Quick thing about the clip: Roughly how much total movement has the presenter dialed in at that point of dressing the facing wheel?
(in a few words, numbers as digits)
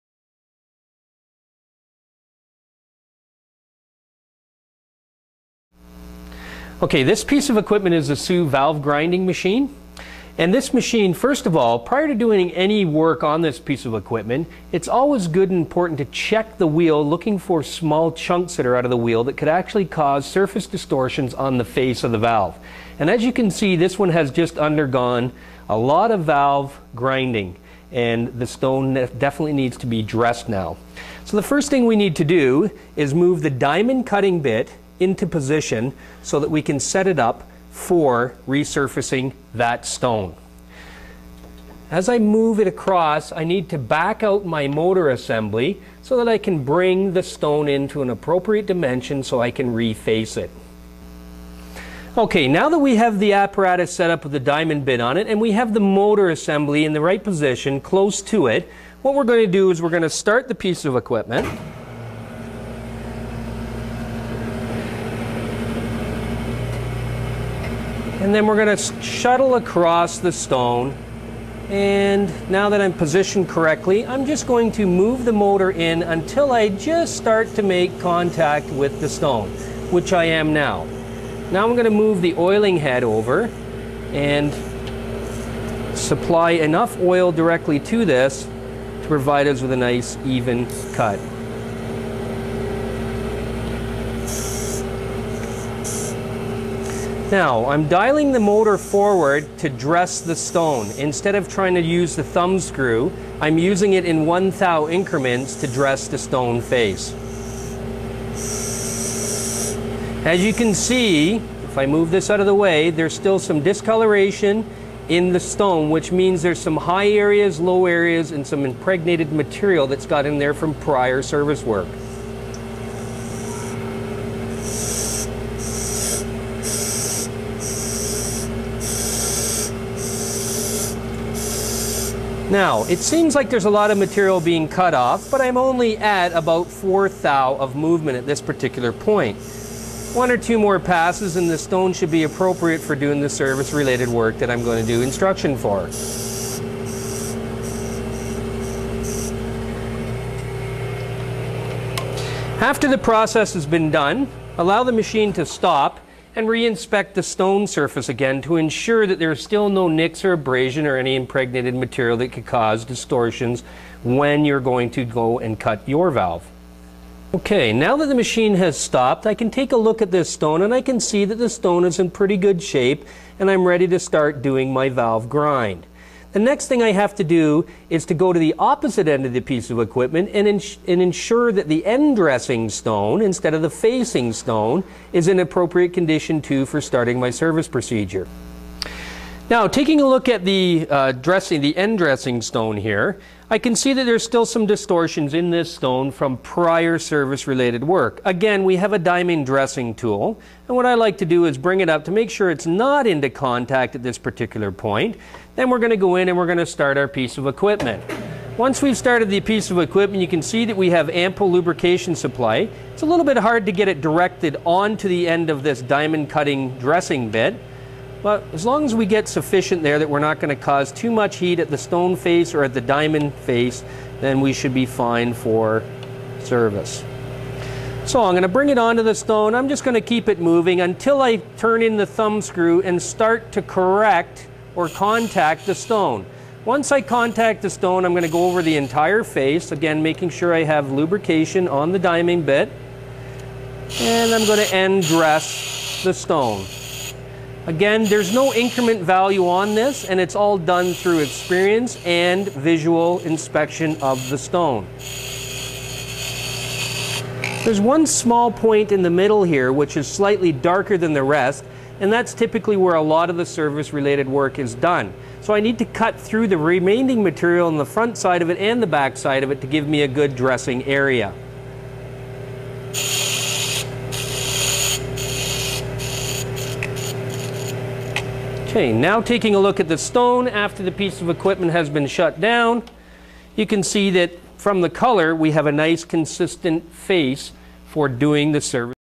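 4 thou.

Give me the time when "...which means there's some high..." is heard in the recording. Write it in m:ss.
1:55.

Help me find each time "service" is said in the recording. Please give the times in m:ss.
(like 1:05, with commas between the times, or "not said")
2:01, 2:23, 3:07, 3:16, 3:46, 4:23, 4:48.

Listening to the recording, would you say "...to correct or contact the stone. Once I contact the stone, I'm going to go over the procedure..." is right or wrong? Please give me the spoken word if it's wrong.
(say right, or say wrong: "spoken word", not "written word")
wrong: "entire", not "procedure".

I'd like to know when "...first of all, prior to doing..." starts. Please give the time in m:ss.
0:11.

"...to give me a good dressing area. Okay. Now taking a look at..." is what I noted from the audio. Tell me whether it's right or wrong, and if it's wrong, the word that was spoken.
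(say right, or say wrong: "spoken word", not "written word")
right.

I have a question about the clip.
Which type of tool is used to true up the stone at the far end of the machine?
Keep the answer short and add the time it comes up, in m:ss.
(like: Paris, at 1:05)
diamond dressing tool, at 3:18.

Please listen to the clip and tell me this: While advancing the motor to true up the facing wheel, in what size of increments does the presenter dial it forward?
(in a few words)
1 thou.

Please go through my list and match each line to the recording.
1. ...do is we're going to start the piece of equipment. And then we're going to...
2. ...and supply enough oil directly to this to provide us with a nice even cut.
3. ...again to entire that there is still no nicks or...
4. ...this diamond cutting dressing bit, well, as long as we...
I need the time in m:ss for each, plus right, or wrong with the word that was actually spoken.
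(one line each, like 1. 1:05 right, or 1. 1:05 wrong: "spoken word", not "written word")
1. 0:59 right
2. 1:24 right
3. 2:38 wrong: "ensure", not "entire"
4. 3:35 right.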